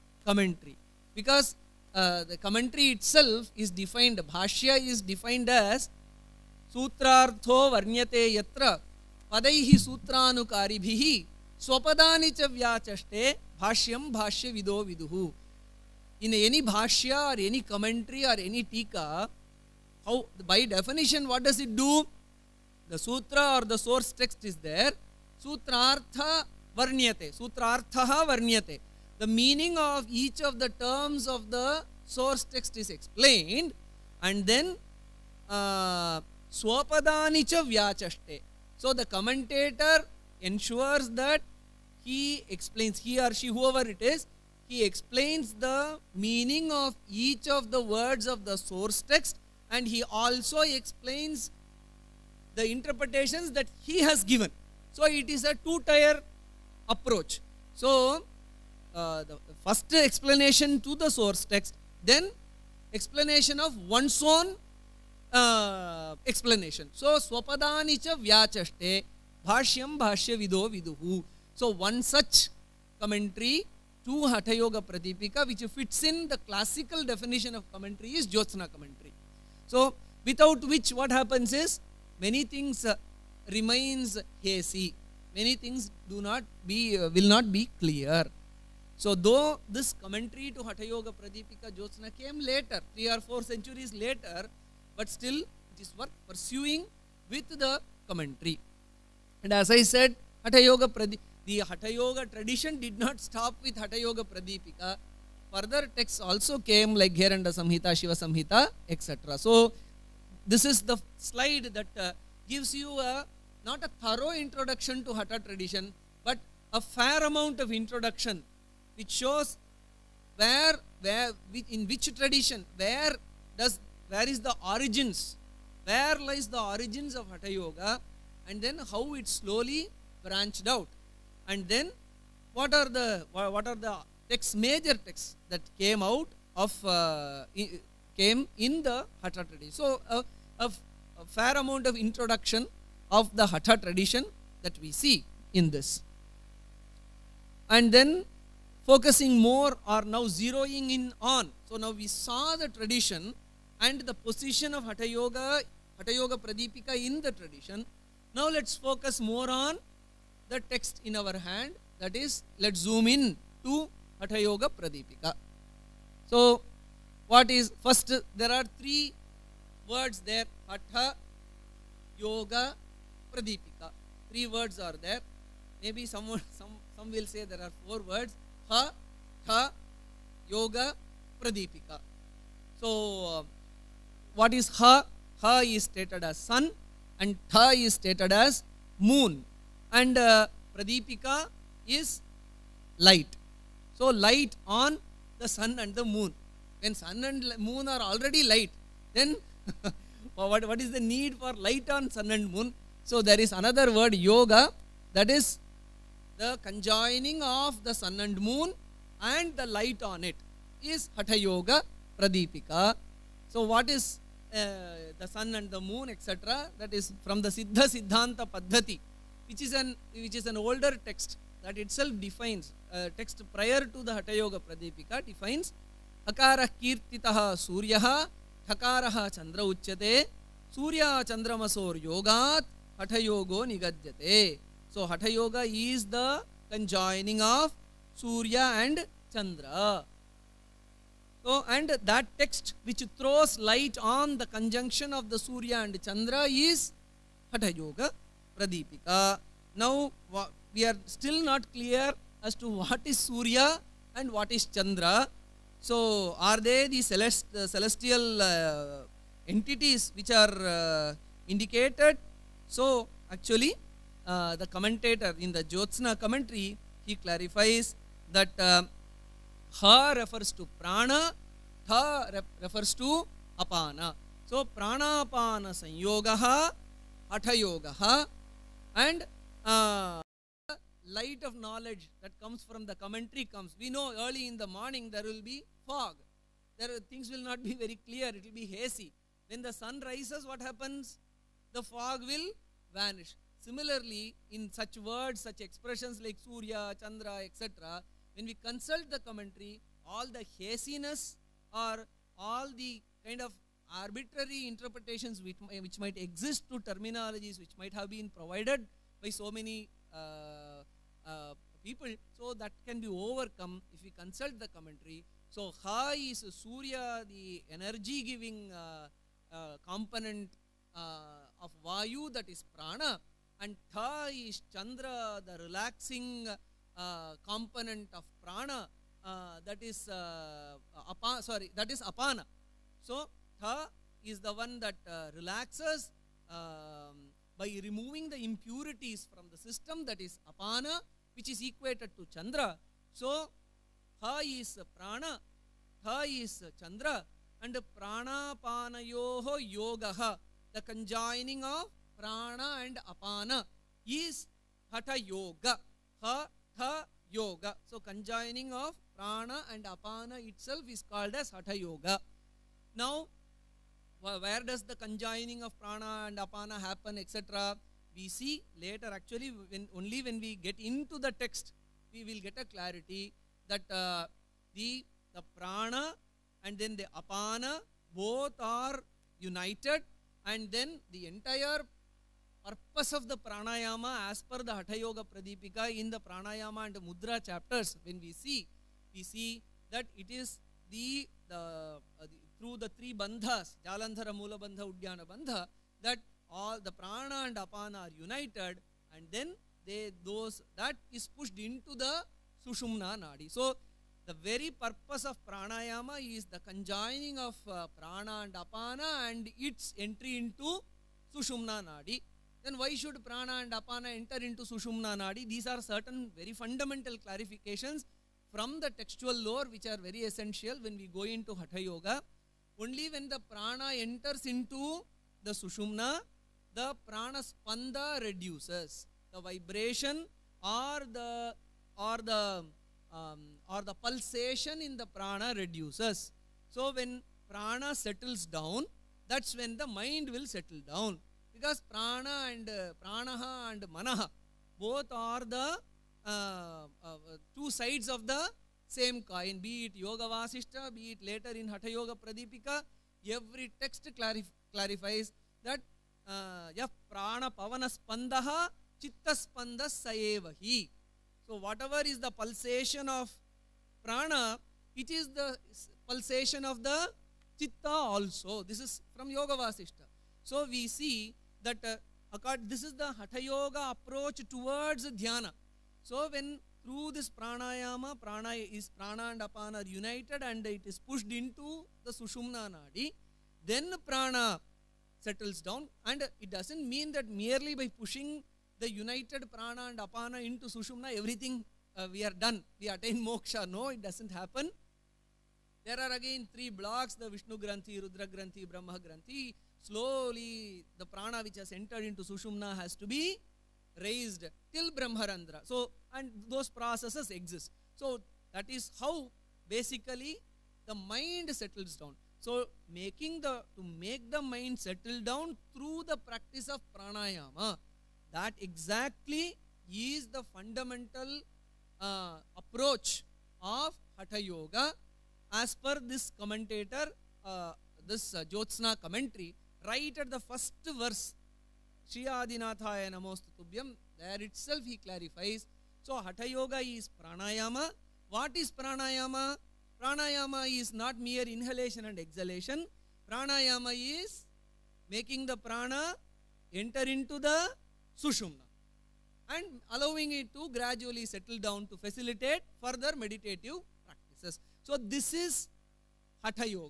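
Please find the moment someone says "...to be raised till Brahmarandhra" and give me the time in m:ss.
8:22.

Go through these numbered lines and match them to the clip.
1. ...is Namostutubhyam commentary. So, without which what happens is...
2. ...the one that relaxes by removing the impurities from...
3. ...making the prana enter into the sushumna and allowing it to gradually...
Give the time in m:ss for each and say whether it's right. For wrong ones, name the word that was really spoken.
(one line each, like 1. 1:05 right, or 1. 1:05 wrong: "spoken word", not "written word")
1. 1:18 wrong: "Jyotsna", not "Namostutubhyam"
2. 5:34 right
3. 9:05 right.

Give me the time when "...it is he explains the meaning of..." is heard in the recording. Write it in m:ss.
0:43.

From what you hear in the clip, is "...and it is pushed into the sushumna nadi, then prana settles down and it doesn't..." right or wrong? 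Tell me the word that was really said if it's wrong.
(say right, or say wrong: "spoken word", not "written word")
right.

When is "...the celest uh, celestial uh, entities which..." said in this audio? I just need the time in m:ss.
4:16.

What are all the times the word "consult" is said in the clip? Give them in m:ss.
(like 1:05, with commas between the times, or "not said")
4:58, 5:14.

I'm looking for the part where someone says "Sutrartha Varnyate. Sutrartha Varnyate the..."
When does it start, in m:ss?
0:25.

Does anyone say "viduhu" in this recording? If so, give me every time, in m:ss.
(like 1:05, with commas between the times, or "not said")
0:14, 1:10.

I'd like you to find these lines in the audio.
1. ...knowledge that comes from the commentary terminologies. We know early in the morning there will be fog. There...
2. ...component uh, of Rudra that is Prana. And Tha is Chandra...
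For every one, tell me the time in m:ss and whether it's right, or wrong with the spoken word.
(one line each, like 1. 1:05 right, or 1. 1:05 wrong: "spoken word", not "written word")
1. 4:41 wrong: "comes", not "terminologies"
2. 5:19 wrong: "Vayu", not "Rudra".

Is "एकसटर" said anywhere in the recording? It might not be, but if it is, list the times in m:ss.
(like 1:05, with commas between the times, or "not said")
3:36.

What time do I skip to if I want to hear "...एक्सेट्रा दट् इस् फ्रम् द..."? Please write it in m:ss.
3:36.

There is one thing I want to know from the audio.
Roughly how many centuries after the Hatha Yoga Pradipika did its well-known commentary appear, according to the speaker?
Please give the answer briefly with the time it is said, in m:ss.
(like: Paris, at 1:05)
three or four centuries, at 1:32.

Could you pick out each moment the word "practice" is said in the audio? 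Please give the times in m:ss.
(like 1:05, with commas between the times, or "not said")
8:36, 9:14.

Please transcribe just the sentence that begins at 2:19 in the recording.
So uh, a fair amount of introduction of the Hatha tradition that we see in this.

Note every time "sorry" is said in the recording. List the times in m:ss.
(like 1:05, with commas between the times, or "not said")
5:31.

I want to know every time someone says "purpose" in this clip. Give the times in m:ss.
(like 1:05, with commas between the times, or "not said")
6:22, 6:44.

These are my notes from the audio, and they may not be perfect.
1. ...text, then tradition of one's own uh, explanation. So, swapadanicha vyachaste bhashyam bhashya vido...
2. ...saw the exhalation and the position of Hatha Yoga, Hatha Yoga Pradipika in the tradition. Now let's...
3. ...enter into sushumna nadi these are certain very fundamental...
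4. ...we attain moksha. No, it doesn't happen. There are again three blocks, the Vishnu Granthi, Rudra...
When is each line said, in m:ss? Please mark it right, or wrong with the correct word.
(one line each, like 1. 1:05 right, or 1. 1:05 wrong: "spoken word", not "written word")
1. 1:01 wrong: "explanation", not "tradition"
2. 2:32 wrong: "tradition", not "exhalation"
3. 6:54 right
4. 8:12 right.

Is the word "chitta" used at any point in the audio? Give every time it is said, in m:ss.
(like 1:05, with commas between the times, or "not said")
7:39, 7:47.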